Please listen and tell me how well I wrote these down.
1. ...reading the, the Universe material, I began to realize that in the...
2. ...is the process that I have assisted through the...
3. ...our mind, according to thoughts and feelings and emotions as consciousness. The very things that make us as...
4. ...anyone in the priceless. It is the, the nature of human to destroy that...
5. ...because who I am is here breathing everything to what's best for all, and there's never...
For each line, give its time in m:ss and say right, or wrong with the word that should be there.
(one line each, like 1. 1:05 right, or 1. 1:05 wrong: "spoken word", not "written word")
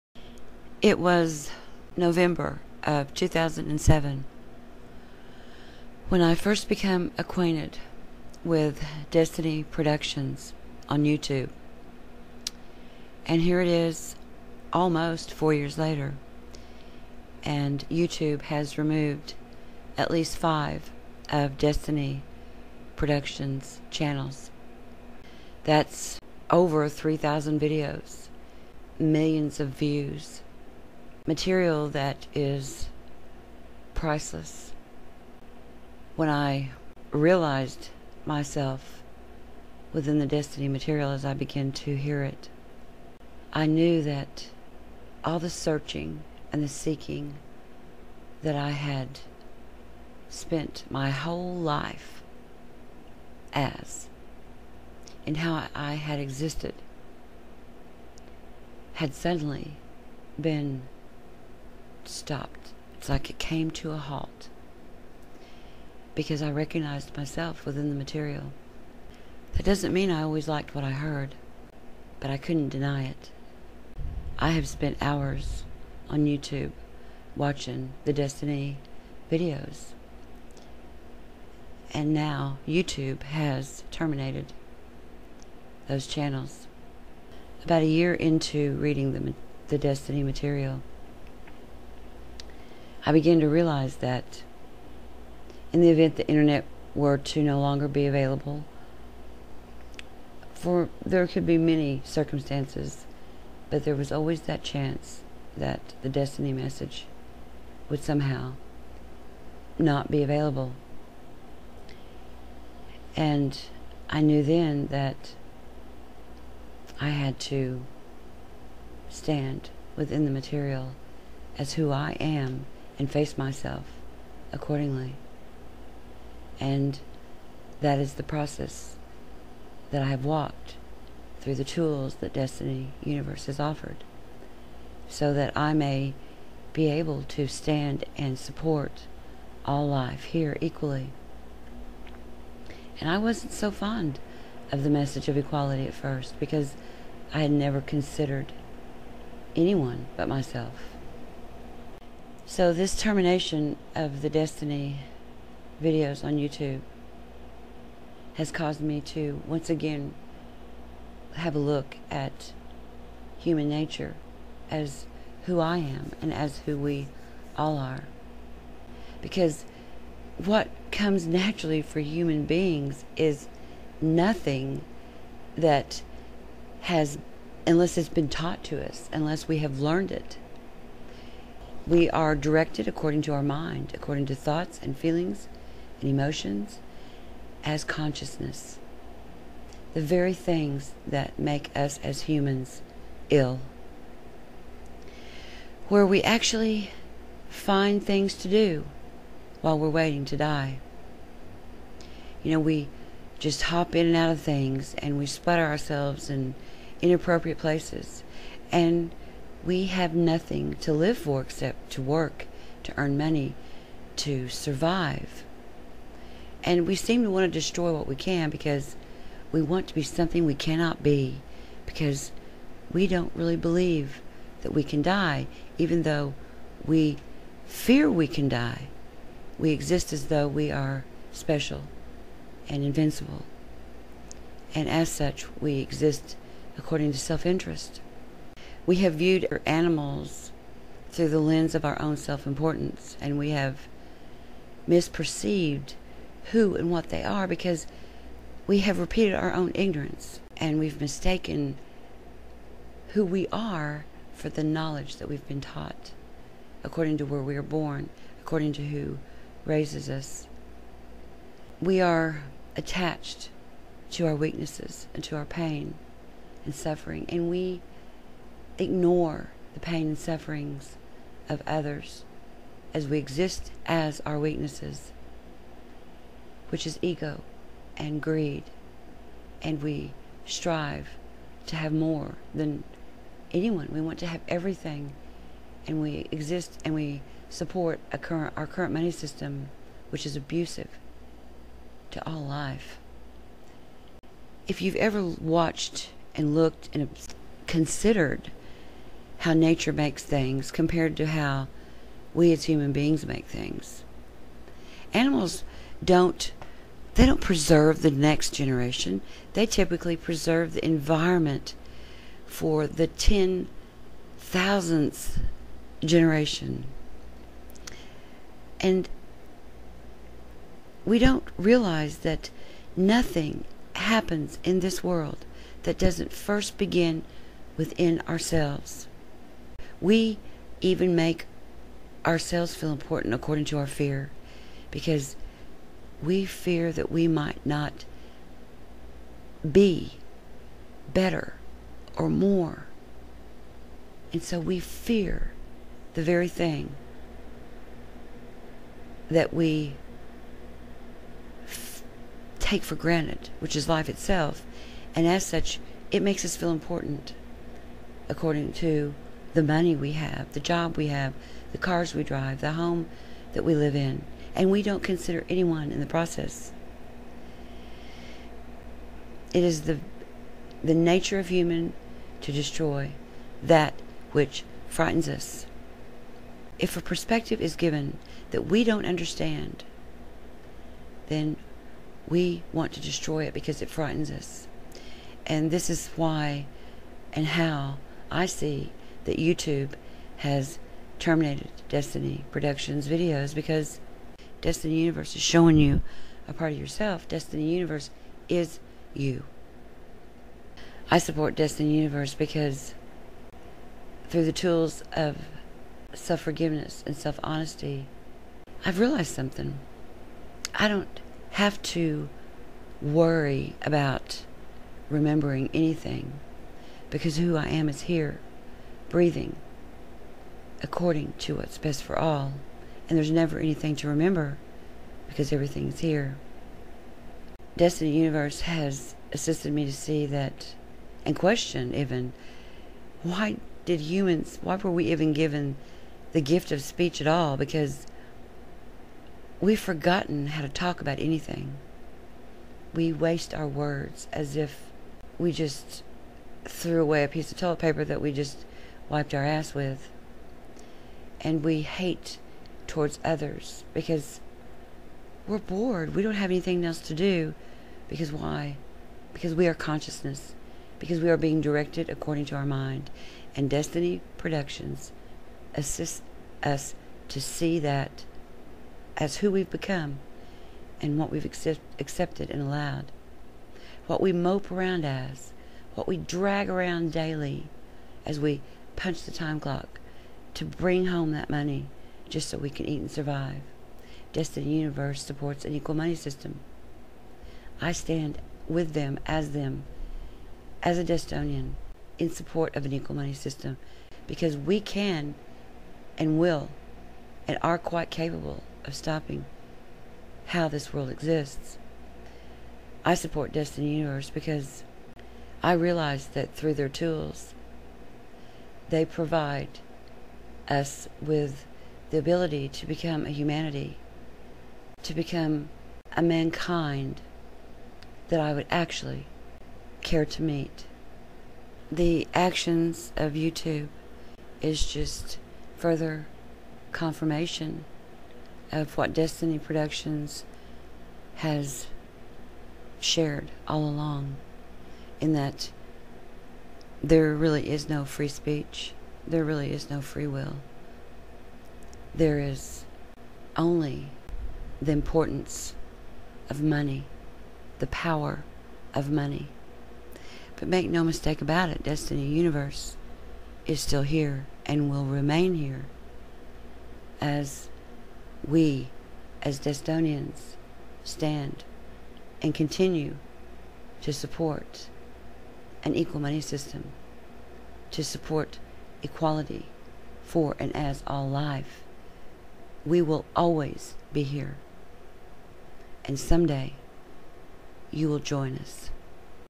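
1. 1:28 wrong: "Desteni", not "Universe"
2. 2:07 wrong: "walked", not "assisted"
3. 3:03 right
4. 6:05 wrong: "process", not "priceless"
5. 6:57 wrong: "according", not "everything".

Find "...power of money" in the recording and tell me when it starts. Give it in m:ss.
9:07.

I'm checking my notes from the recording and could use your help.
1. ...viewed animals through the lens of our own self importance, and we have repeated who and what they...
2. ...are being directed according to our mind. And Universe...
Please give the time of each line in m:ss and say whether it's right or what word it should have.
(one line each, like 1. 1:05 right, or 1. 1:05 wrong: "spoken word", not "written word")
1. 3:59 wrong: "misperceived", not "repeated"
2. 7:41 wrong: "Desteni", not "Universe".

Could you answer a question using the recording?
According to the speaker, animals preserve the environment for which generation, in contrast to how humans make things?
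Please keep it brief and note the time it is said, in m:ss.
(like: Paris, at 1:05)
10,000th generation, at 5:13.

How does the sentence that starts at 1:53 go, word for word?
And I knew then that I had to stand within the material as who I am and face myself accordingly.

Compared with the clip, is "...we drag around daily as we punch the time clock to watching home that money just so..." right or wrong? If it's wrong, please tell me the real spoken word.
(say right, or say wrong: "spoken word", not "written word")
wrong: "bring", not "watching".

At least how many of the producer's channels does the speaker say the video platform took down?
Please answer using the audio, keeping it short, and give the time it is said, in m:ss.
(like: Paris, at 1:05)
5, at 0:20.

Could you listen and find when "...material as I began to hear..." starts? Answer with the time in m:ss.
0:40.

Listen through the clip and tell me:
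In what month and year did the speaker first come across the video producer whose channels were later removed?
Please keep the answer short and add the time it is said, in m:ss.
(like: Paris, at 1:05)
November 2007, at 0:01.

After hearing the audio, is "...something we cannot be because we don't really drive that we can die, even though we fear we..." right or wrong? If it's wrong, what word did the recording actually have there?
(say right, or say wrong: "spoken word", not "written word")
wrong: "believe", not "drive".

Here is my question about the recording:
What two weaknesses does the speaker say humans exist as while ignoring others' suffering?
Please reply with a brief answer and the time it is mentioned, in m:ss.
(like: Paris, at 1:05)
Ego and greed, at 4:37.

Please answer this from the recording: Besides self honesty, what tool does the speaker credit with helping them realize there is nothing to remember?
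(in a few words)
Self forgiveness.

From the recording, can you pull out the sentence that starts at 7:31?
And we hate towards others because we're bored.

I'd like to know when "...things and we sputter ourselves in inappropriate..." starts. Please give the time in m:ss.
3:24.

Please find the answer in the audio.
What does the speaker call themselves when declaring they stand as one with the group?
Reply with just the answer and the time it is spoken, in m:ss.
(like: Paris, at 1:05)
Destonian, at 8:10.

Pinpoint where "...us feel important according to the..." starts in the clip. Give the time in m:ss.
5:56.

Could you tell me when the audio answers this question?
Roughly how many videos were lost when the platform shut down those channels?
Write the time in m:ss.
0:26.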